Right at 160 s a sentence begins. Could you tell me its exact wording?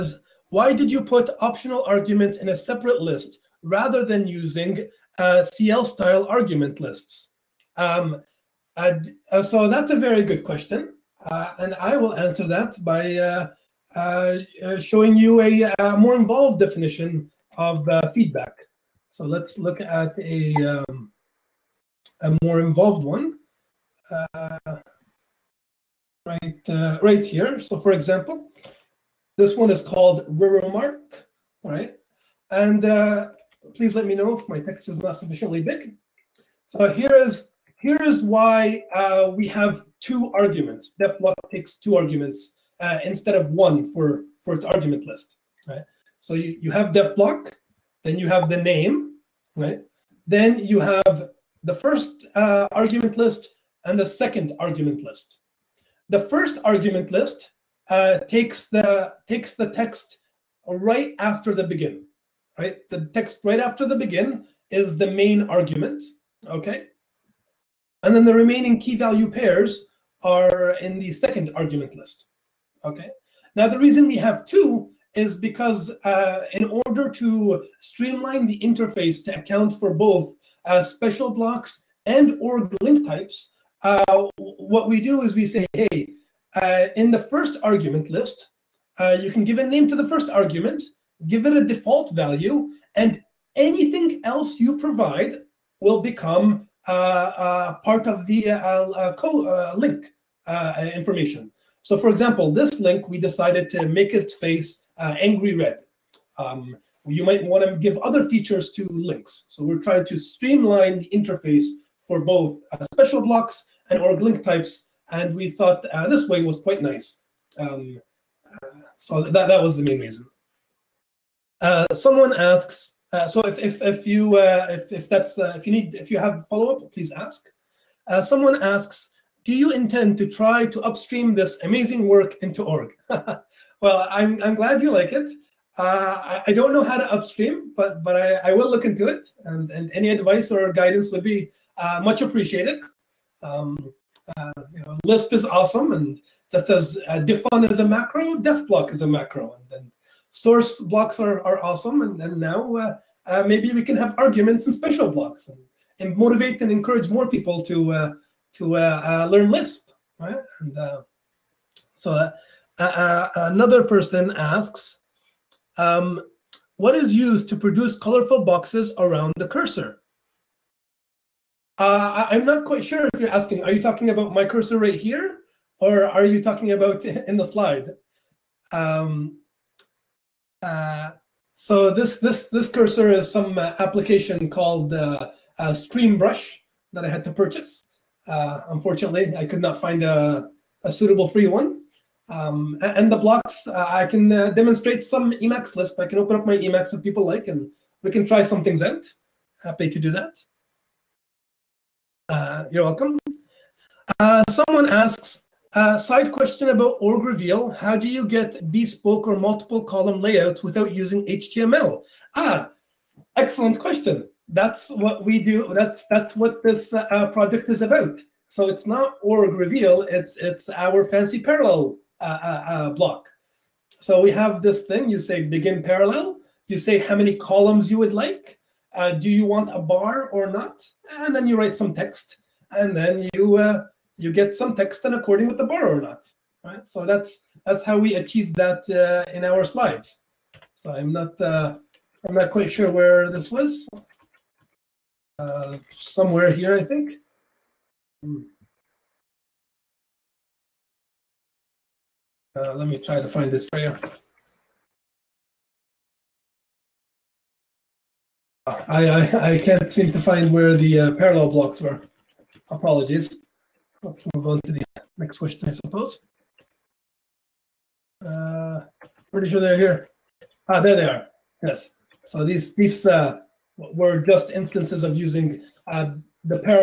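And so another person asks, um, what is used to produce colorful boxes around the cursor?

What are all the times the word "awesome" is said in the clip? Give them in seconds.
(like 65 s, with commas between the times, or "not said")
145 s, 151 s.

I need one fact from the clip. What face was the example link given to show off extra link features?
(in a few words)
angry red.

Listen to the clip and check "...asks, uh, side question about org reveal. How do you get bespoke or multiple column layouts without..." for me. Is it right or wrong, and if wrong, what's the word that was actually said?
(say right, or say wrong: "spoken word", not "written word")
right.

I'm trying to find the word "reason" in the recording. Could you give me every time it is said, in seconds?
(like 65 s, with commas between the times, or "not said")
73 s, 119 s.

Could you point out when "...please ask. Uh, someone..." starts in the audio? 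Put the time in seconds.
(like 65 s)
126 s.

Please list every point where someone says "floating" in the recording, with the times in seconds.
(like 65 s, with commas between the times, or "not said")
not said.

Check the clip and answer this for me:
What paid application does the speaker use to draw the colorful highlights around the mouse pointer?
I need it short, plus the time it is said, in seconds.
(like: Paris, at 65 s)
ScreenBrush, at 185 s.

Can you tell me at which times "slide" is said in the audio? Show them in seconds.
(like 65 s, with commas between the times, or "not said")
177 s, 239 s.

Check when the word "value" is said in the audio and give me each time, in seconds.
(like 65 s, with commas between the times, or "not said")
68 s, 92 s.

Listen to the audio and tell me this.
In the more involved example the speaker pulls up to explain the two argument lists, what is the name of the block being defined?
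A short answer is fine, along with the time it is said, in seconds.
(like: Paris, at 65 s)
remark, at 30 s.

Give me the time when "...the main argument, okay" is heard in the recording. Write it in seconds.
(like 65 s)
64 s.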